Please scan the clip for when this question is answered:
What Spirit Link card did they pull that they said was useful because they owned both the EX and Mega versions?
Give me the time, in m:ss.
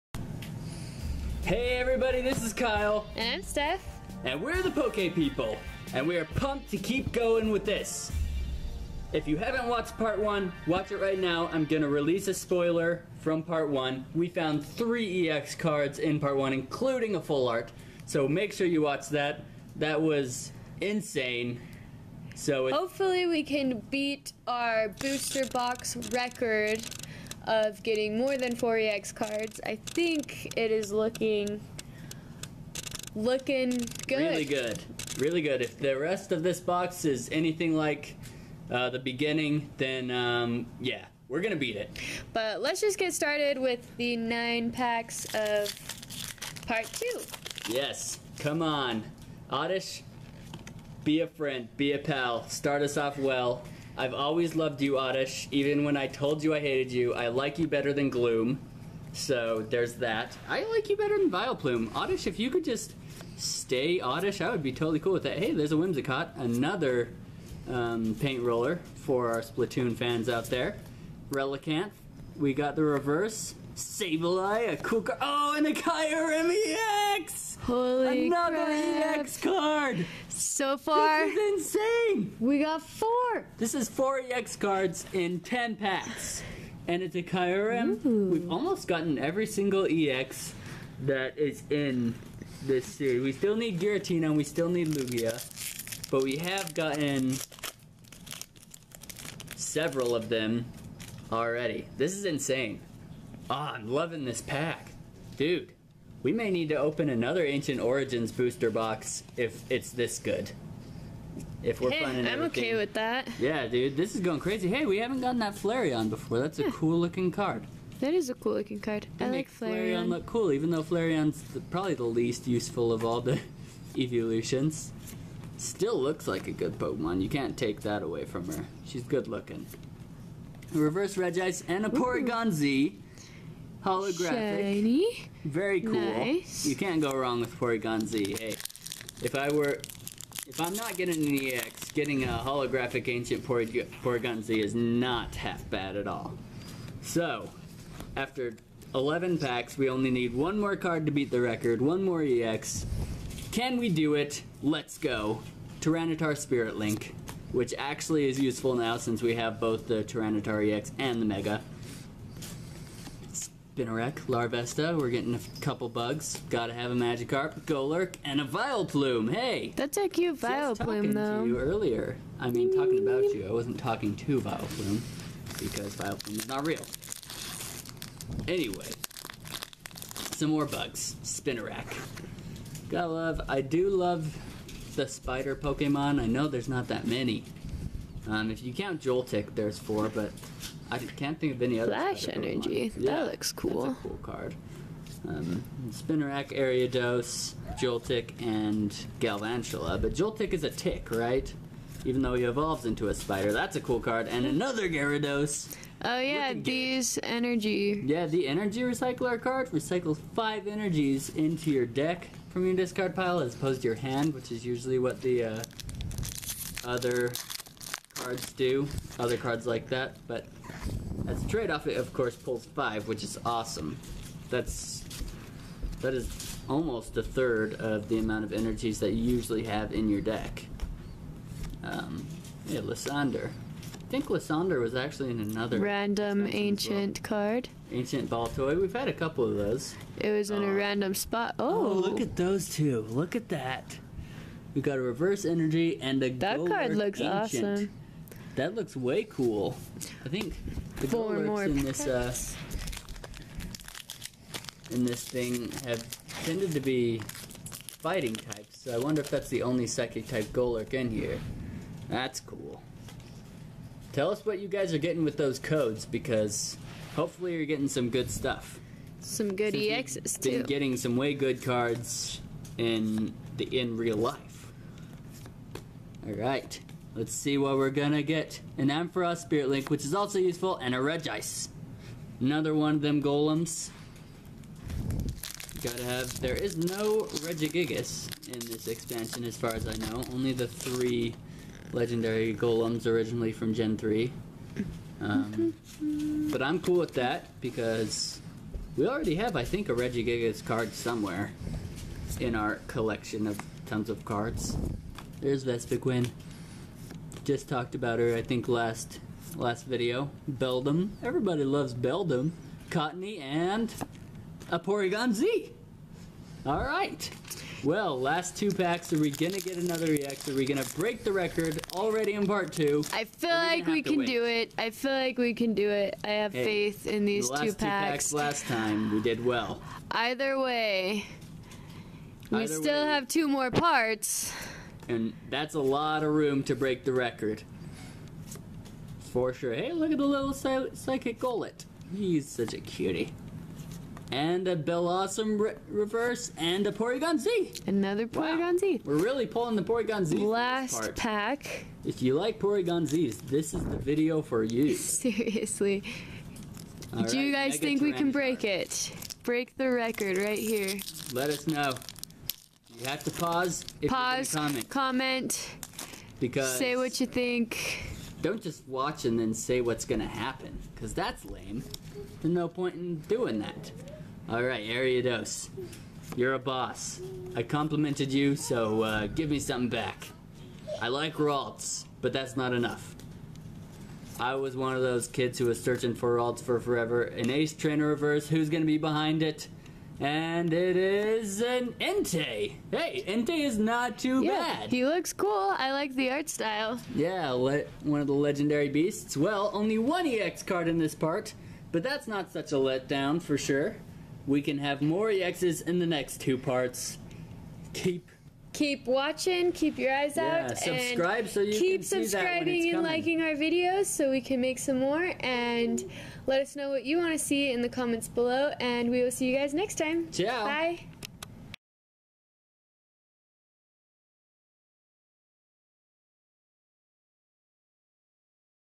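2:35.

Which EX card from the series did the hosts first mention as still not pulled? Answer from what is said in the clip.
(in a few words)
Giratina.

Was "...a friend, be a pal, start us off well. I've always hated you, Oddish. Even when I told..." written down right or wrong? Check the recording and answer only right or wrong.
wrong.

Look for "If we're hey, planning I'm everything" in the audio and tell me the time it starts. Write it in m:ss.
1:51.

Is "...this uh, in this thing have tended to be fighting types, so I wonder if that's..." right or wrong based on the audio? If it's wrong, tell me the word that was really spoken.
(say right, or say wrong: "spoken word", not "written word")
right.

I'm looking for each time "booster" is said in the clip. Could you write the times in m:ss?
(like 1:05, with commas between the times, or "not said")
0:24, 1:48.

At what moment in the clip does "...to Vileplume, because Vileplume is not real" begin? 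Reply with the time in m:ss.
2:54.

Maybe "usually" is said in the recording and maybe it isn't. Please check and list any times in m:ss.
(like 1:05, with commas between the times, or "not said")
3:34, 3:49.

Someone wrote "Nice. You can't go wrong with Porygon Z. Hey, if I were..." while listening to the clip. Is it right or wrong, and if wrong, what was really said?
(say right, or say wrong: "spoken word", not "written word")
right.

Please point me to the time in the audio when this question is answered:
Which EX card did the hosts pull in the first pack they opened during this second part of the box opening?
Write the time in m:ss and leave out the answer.
1:15.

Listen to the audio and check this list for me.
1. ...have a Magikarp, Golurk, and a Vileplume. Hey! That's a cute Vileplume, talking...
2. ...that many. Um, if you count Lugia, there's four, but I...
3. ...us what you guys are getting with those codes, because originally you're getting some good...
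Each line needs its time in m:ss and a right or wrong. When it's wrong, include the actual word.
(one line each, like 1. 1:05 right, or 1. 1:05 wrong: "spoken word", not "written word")
1. 2:46 right
2. 3:06 wrong: "Joltik", not "Lugia"
3. 4:24 wrong: "hopefully", not "originally".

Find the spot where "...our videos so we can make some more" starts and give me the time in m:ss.
6:53.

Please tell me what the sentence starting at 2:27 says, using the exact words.
So, after 11 packs, we only need one more card to beat the record, one more EX.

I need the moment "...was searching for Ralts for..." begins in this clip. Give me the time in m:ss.
6:25.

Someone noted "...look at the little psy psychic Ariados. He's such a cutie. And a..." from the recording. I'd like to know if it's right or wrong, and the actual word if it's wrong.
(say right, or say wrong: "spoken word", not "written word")
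wrong: "Golett", not "Ariados".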